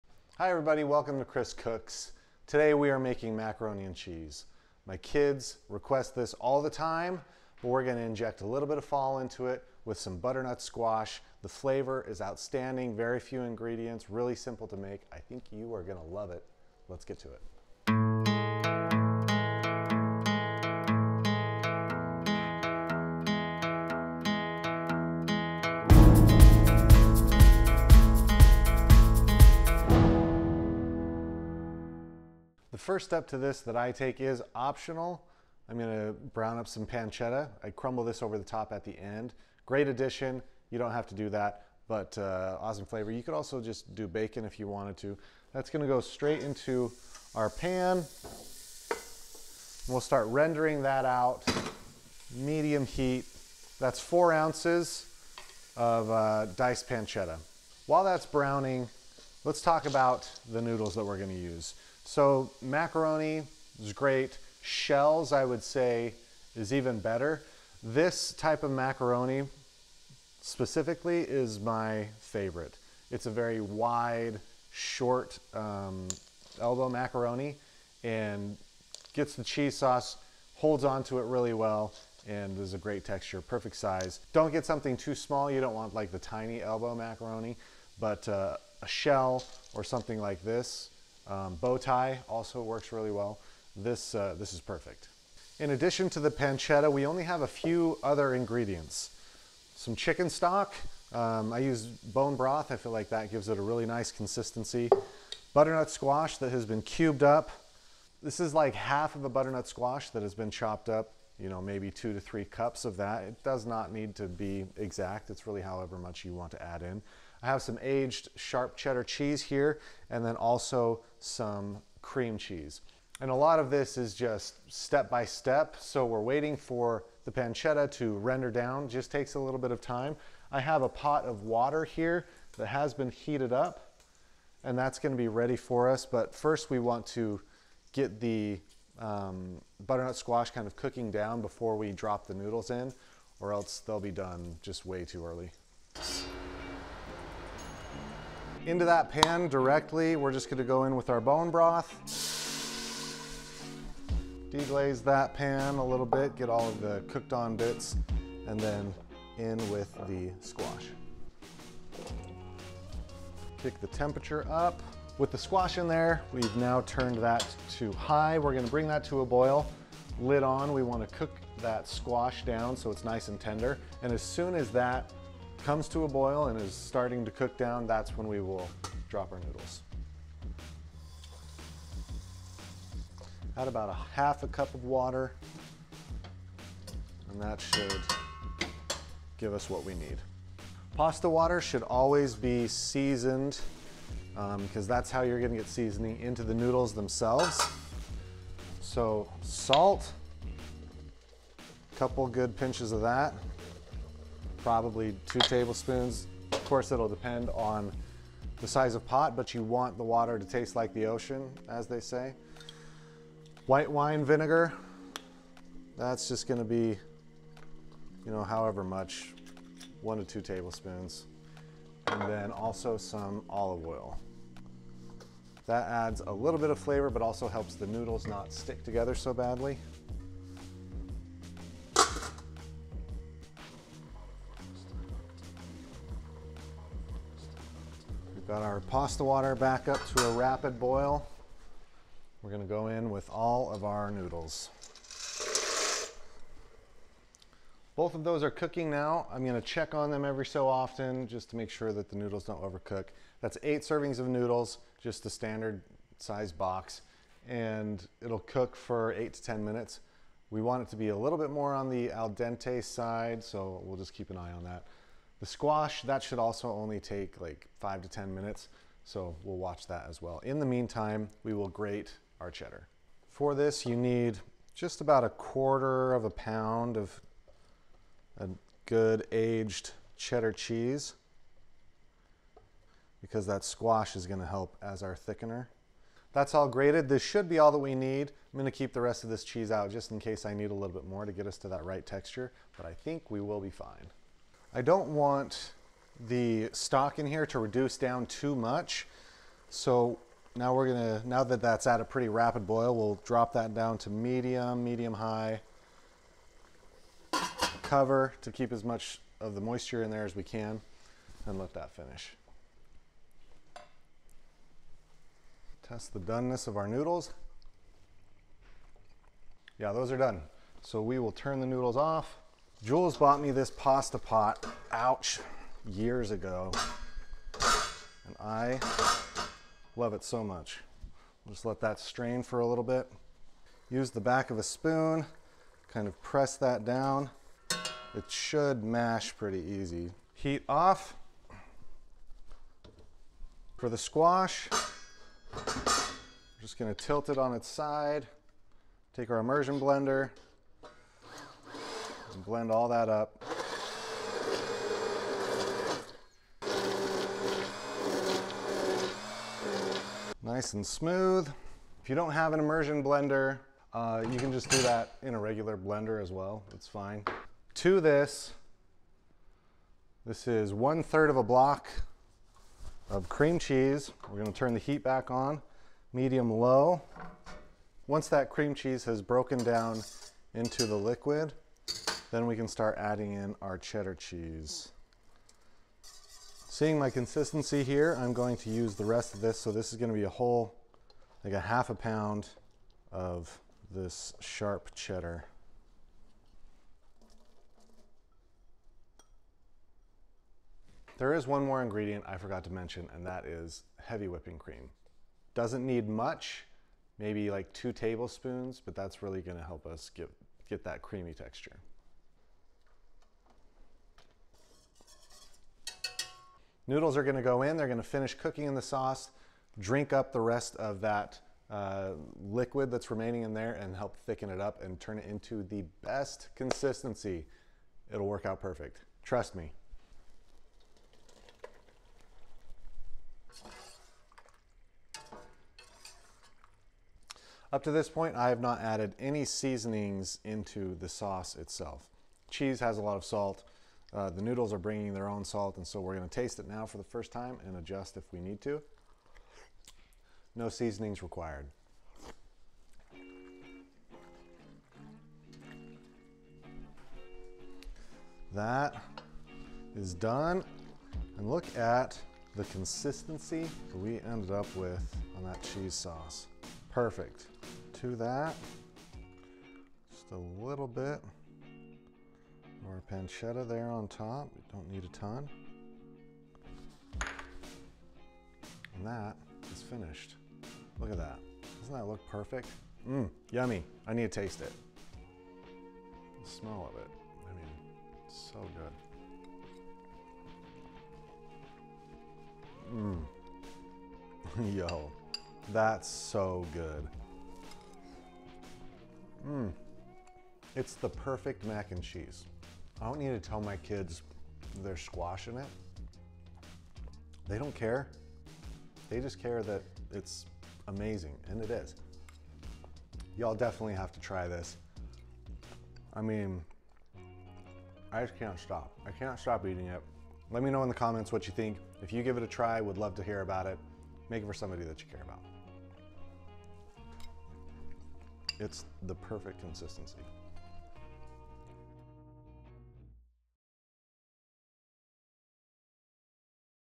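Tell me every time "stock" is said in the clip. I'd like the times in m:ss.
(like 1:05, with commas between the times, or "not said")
1:40, 4:56.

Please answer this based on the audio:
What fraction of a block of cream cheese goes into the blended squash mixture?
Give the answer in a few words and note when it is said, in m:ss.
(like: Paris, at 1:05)
one third, at 6:10.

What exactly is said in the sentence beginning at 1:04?
Shells, I would say, is even better.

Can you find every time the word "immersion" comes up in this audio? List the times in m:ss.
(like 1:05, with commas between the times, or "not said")
5:49, 6:02.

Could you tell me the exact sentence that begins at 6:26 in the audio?
Seeing my consistency here, I'm going to use the rest of this.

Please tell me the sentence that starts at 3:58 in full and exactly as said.
Got our pasta water back up to a rapid boil.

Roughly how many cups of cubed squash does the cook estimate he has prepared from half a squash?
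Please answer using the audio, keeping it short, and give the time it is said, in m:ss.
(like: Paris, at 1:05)
2 to 3 cups, at 1:51.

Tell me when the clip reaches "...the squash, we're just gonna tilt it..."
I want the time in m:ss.
5:43.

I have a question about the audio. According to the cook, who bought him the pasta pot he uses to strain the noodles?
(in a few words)
Jules.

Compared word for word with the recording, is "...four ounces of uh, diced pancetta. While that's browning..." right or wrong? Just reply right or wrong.
right.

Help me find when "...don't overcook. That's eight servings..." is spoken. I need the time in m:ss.
4:12.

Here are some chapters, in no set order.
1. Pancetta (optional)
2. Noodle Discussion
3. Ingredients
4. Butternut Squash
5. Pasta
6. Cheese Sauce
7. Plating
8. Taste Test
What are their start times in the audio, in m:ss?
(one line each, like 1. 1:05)
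1. 0:32
2. 0:58
3. 1:37
4. 2:28
5. 3:12
6. 4:30
7. 7:35
8. 8:05.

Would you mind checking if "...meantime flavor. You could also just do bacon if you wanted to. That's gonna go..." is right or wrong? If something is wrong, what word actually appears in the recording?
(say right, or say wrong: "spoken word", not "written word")
wrong: "awesome", not "meantime".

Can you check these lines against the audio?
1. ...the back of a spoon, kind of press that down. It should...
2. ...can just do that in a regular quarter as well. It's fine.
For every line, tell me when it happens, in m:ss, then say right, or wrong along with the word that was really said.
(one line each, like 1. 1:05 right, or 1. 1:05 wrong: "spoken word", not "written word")
1. 5:34 right
2. 6:04 wrong: "blender", not "quarter".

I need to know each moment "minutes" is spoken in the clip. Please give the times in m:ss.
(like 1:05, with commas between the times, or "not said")
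4:19, 4:28.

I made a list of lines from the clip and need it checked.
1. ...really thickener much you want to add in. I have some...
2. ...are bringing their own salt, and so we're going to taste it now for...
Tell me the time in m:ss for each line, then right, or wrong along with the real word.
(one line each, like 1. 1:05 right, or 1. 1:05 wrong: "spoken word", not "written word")
1. 1:55 wrong: "however", not "thickener"
2. 7:24 right.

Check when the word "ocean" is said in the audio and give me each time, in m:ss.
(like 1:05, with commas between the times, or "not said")
3:31.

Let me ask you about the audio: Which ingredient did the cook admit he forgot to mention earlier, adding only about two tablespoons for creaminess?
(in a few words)
heavy whipping cream.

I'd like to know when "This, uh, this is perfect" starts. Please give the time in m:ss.
1:33.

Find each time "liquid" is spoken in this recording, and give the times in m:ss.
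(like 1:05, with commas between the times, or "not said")
6:20, 7:02.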